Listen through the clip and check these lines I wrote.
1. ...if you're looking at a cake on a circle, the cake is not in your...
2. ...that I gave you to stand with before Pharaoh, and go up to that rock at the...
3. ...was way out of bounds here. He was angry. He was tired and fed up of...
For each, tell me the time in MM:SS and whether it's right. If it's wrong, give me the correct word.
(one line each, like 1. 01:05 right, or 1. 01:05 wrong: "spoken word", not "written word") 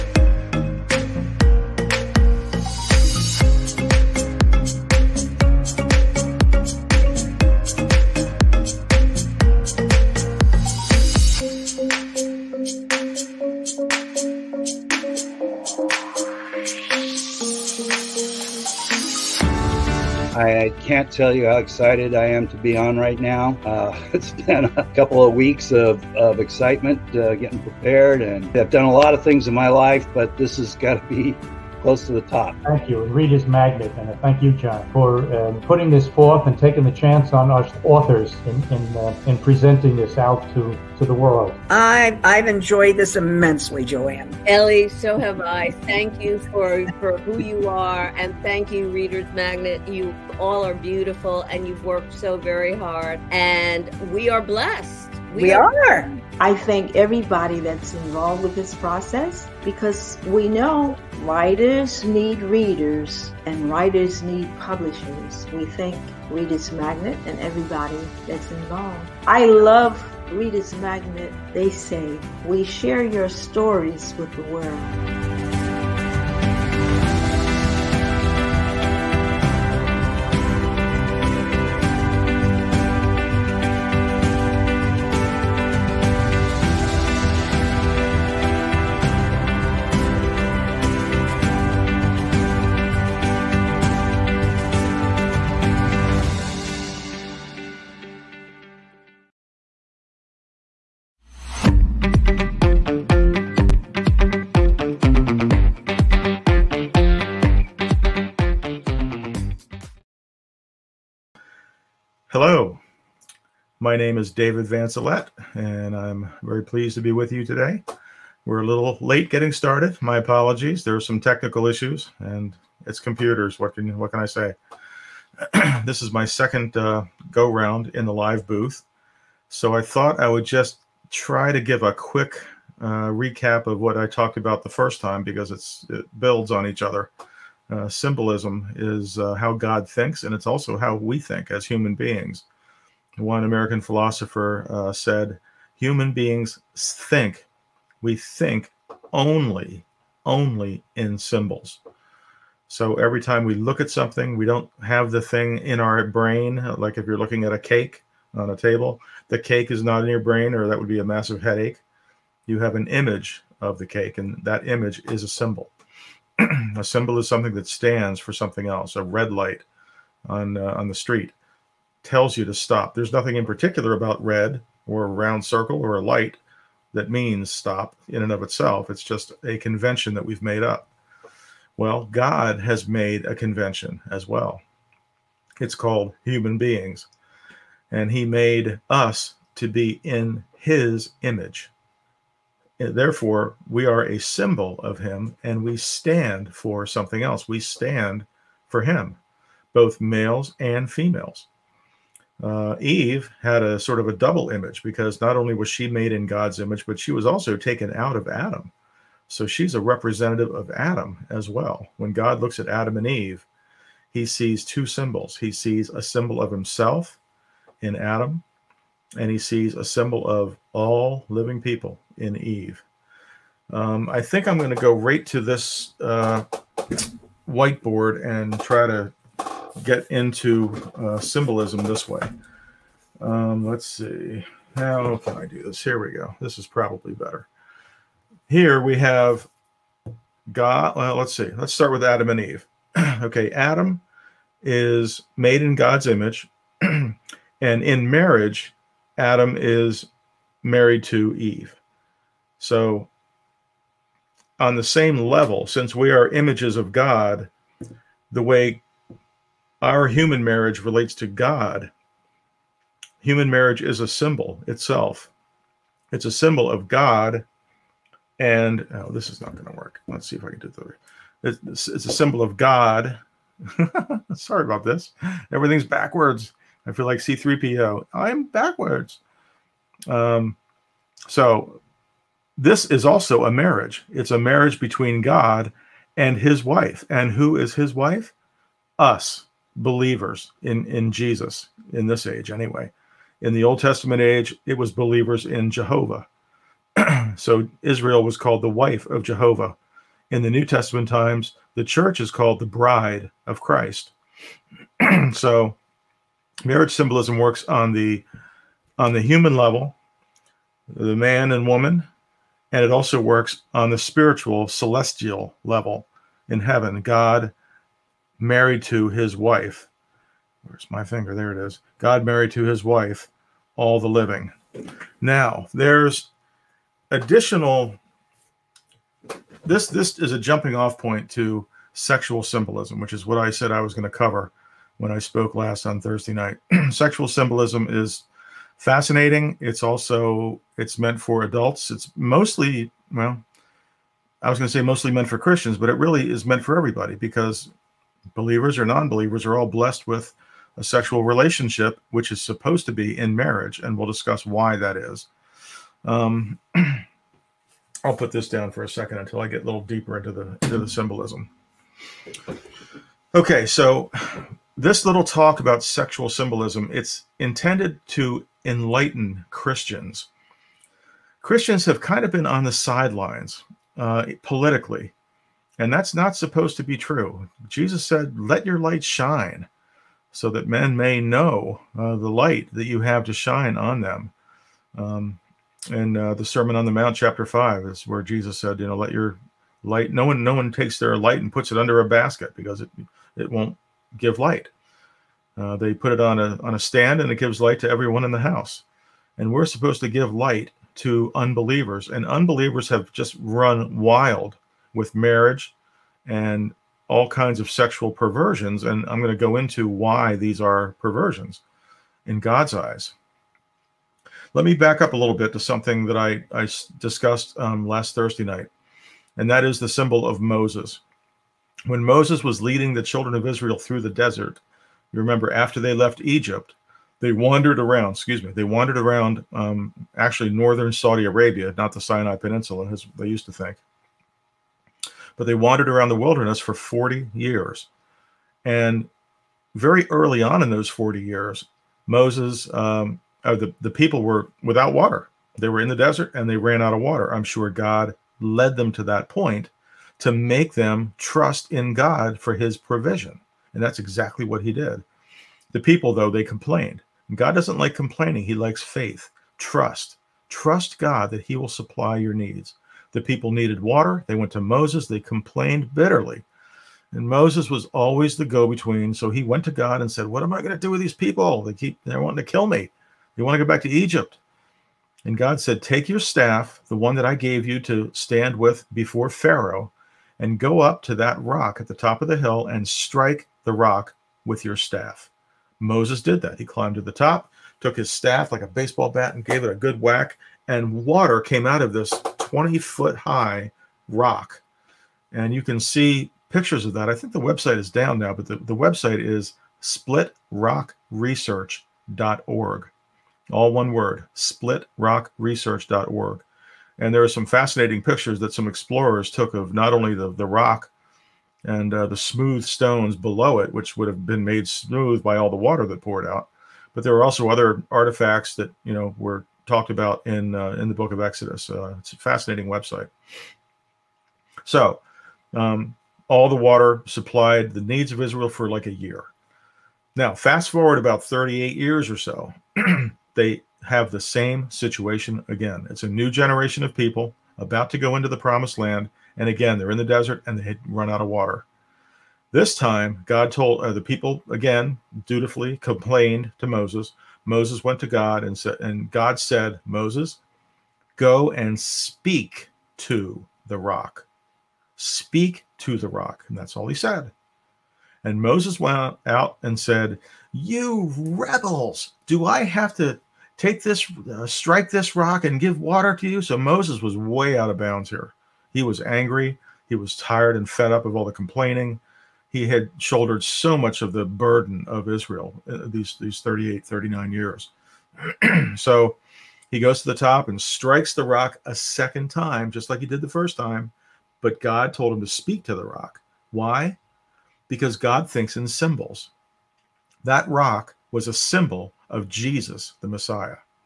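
1. 02:36 wrong: "table", not "circle"
2. 07:57 right
3. 09:27 right.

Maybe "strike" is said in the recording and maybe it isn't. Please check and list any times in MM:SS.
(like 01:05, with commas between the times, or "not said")
08:02, 09:24, 09:40.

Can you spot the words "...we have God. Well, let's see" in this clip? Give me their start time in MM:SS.
03:58.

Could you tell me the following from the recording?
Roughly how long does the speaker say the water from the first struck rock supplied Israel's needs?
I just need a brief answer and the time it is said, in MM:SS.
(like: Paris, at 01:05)
a year, at 08:48.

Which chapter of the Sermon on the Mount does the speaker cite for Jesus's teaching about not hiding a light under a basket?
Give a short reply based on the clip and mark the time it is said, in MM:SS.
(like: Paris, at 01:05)
chapter 5, at 06:27.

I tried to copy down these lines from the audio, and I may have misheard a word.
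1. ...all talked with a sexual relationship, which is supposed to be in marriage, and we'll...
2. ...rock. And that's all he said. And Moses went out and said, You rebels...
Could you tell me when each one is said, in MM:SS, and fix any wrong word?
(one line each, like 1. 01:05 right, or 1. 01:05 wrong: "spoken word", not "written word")
1. 05:49 wrong: "blessed", not "talked"
2. 09:16 right.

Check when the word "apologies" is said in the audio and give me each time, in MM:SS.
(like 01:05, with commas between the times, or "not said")
02:00.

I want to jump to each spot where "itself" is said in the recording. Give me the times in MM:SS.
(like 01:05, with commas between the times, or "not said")
02:58, 04:24.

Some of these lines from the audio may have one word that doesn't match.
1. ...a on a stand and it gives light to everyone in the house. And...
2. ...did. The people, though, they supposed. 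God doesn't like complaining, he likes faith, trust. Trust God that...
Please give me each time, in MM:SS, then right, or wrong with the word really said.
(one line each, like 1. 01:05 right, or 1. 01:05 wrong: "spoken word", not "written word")
1. 06:36 right
2. 07:34 wrong: "complained", not "supposed".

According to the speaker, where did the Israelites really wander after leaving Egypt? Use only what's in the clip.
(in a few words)
northern Saudi Arabia.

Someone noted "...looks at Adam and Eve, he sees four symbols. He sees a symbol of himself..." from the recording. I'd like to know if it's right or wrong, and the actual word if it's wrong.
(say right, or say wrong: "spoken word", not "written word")
wrong: "two", not "four".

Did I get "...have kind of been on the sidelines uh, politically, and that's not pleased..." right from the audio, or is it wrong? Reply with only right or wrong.
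wrong.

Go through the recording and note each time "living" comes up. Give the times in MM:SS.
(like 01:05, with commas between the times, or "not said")
03:41, 05:24.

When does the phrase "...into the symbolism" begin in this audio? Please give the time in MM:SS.
06:00.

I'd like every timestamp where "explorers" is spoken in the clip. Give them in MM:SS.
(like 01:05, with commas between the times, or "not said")
08:28.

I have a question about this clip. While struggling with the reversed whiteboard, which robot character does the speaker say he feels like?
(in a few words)
C3PO.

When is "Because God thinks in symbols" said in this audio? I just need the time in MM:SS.
09:47.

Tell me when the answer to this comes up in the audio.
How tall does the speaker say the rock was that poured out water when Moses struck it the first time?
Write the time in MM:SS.
08:12.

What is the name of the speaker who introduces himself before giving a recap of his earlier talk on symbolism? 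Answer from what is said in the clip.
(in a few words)
David Vancelet.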